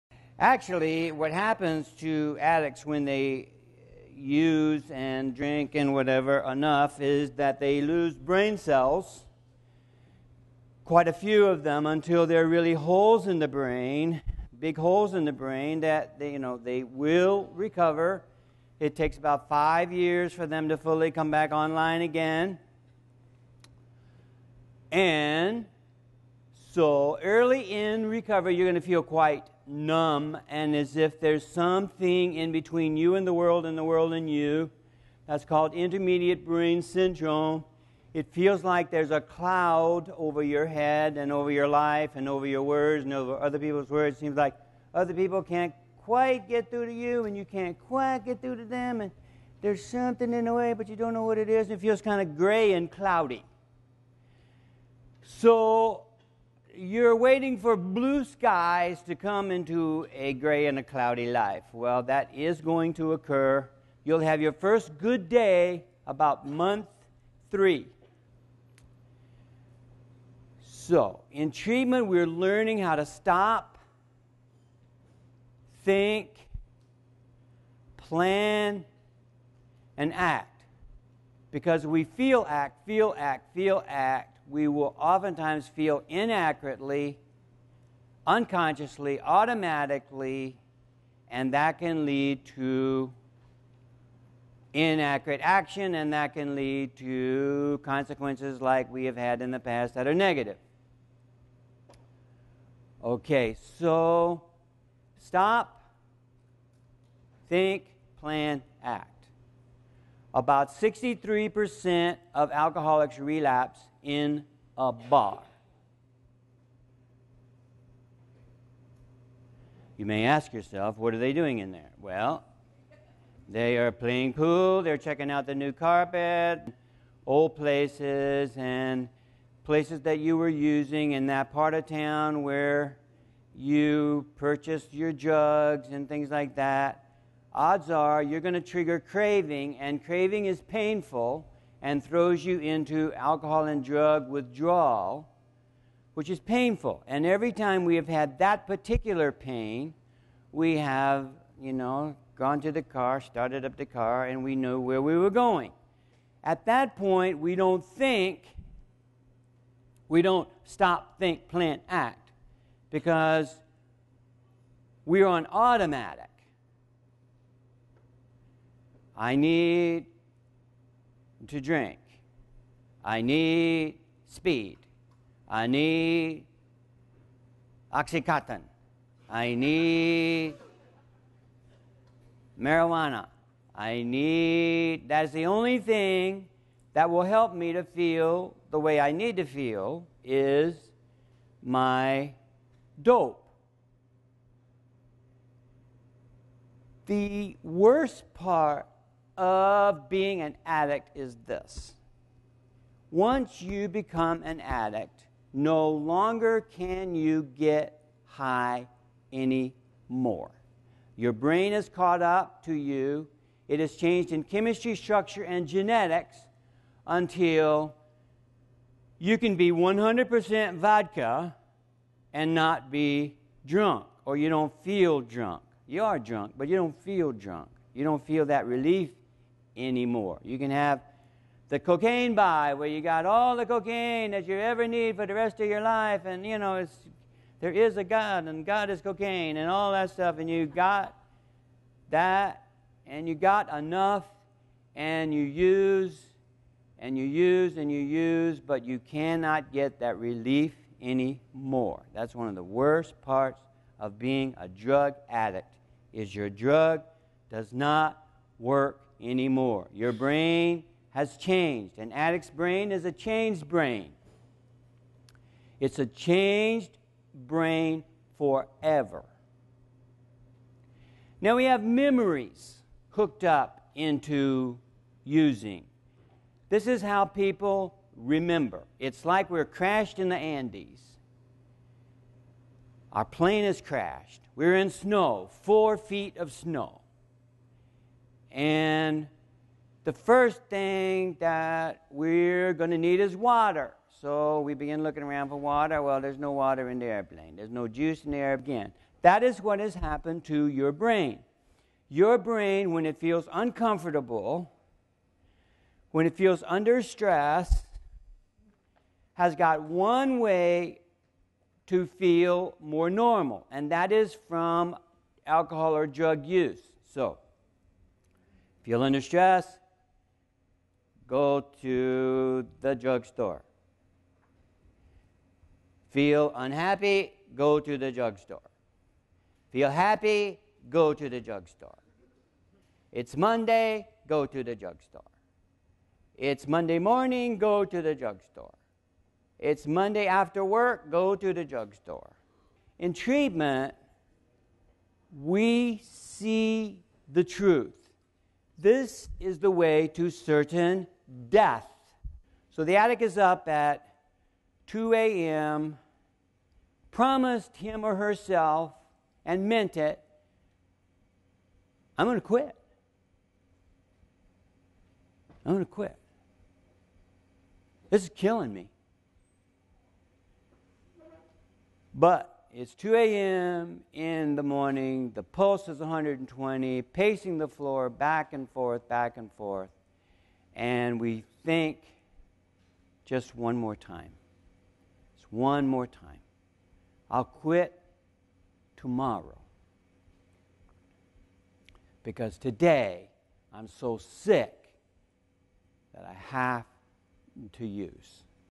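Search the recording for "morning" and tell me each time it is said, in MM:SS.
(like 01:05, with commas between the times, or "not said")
05:36, 06:14.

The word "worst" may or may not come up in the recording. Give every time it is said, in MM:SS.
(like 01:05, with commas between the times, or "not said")
03:17, 04:12.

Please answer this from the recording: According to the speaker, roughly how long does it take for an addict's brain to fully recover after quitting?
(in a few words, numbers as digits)
5 years.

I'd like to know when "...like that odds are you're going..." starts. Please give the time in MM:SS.
02:16.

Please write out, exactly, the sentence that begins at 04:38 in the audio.
It's like we're crashed in the Andes.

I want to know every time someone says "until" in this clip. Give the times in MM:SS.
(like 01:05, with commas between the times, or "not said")
00:11, 03:37.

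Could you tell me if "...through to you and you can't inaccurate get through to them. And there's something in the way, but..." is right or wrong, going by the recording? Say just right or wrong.
wrong.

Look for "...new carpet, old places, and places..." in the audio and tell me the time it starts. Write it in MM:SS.
02:05.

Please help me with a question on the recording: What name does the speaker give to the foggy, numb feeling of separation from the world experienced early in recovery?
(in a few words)
intermediate brain syndrome.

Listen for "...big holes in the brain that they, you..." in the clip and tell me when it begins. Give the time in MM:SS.
00:14.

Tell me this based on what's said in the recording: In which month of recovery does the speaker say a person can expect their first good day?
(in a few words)
month 3.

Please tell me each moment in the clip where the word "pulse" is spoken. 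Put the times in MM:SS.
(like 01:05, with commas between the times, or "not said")
06:15.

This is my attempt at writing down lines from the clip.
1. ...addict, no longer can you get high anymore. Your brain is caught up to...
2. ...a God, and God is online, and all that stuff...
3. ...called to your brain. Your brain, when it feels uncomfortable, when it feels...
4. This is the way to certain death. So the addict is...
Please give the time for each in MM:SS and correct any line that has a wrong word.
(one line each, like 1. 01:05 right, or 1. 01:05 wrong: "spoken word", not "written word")
1. 03:24 right
2. 03:57 wrong: "cocaine", not "online"
3. 04:59 wrong: "happened", not "called"
4. 05:48 right.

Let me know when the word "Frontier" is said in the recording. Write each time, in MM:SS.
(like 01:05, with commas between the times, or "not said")
not said.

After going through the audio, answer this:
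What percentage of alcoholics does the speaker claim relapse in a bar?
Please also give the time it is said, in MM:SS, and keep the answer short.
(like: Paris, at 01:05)
63%, at 01:50.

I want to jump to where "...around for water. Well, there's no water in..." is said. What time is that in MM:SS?
04:55.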